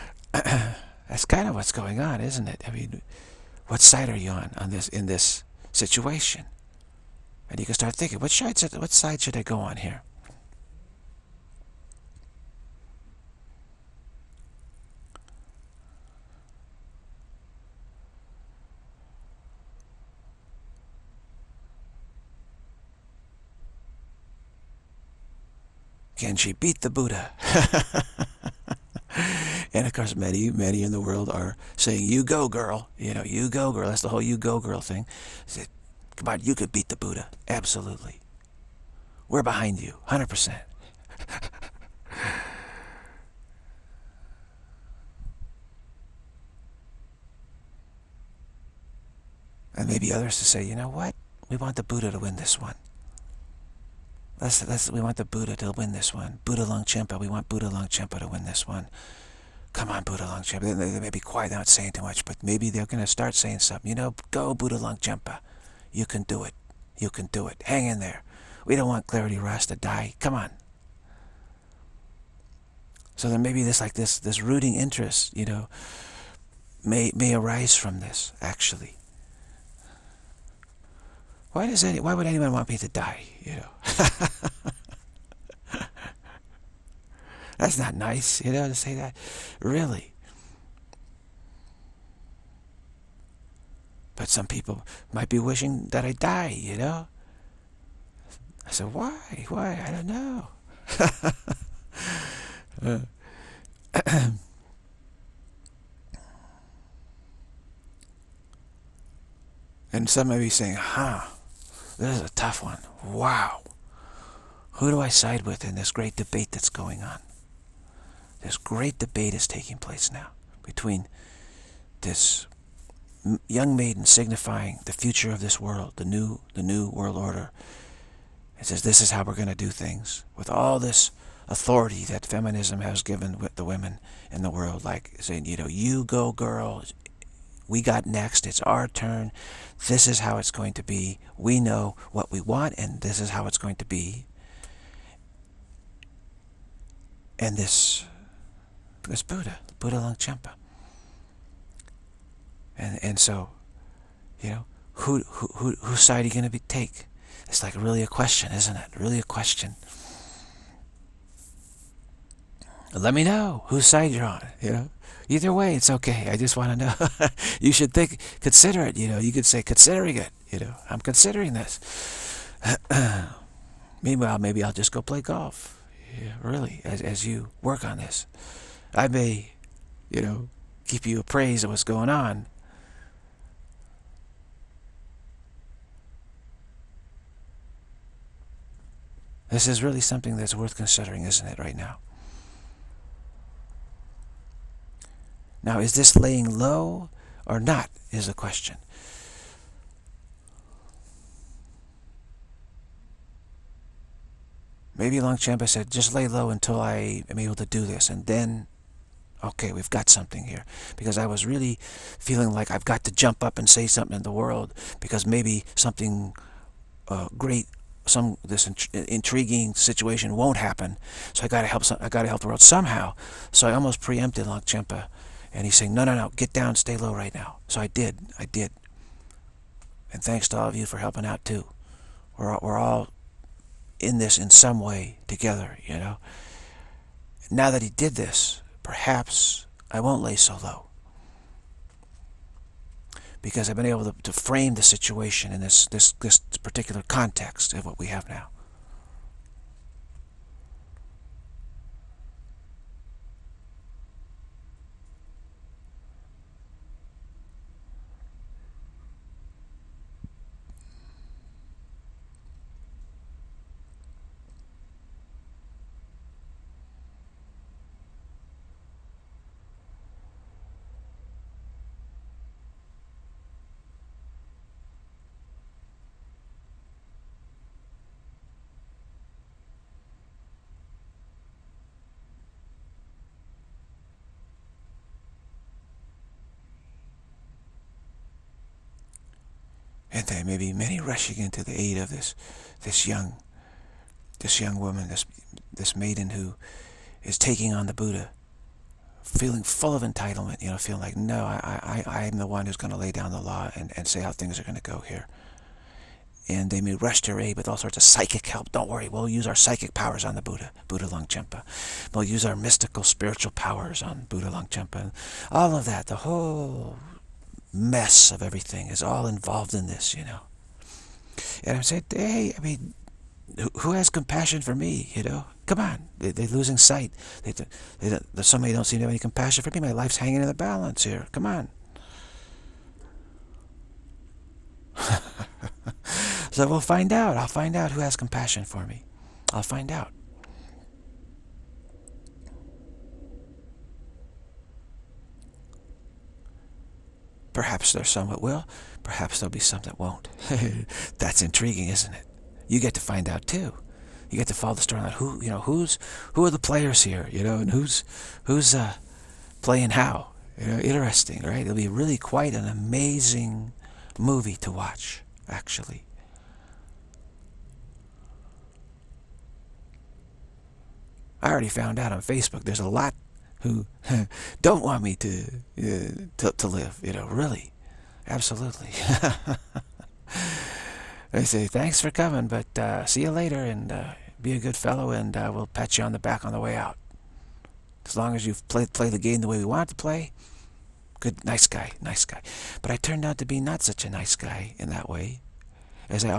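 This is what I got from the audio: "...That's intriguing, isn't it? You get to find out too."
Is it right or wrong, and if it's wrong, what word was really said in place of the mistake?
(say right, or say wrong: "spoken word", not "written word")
right.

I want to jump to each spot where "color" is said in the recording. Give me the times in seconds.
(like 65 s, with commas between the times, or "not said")
not said.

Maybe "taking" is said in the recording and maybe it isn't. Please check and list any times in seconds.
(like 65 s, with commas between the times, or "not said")
119 s, 297 s.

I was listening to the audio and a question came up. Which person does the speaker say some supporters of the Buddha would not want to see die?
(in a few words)
Clarity Ross.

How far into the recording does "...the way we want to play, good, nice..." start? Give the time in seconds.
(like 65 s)
389 s.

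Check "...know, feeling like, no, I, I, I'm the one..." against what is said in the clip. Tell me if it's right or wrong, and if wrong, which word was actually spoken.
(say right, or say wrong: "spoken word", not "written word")
right.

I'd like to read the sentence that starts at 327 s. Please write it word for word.
They, they, they, somebody don't seem to have any compassion for me.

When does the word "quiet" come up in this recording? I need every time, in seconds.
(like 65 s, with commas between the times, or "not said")
61 s.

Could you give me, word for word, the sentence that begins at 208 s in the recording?
And then, okay, we've got something here.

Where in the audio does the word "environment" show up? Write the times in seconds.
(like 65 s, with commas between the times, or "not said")
not said.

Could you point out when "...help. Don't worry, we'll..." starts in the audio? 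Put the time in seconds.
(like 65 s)
308 s.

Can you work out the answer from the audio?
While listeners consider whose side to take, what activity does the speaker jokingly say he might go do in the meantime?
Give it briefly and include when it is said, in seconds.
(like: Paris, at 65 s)
Golf, at 175 s.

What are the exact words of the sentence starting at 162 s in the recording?
Let me know whose side you're on.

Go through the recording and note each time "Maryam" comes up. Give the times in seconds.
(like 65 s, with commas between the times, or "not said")
not said.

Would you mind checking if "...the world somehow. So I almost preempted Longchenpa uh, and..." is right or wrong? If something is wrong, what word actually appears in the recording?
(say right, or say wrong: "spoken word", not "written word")
right.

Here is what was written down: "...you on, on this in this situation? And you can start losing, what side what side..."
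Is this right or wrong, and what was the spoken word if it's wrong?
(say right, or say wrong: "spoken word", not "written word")
wrong: "thinking", not "losing".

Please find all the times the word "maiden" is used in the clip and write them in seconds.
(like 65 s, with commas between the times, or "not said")
123 s, 295 s.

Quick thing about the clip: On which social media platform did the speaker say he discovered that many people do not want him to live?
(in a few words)
Facebook.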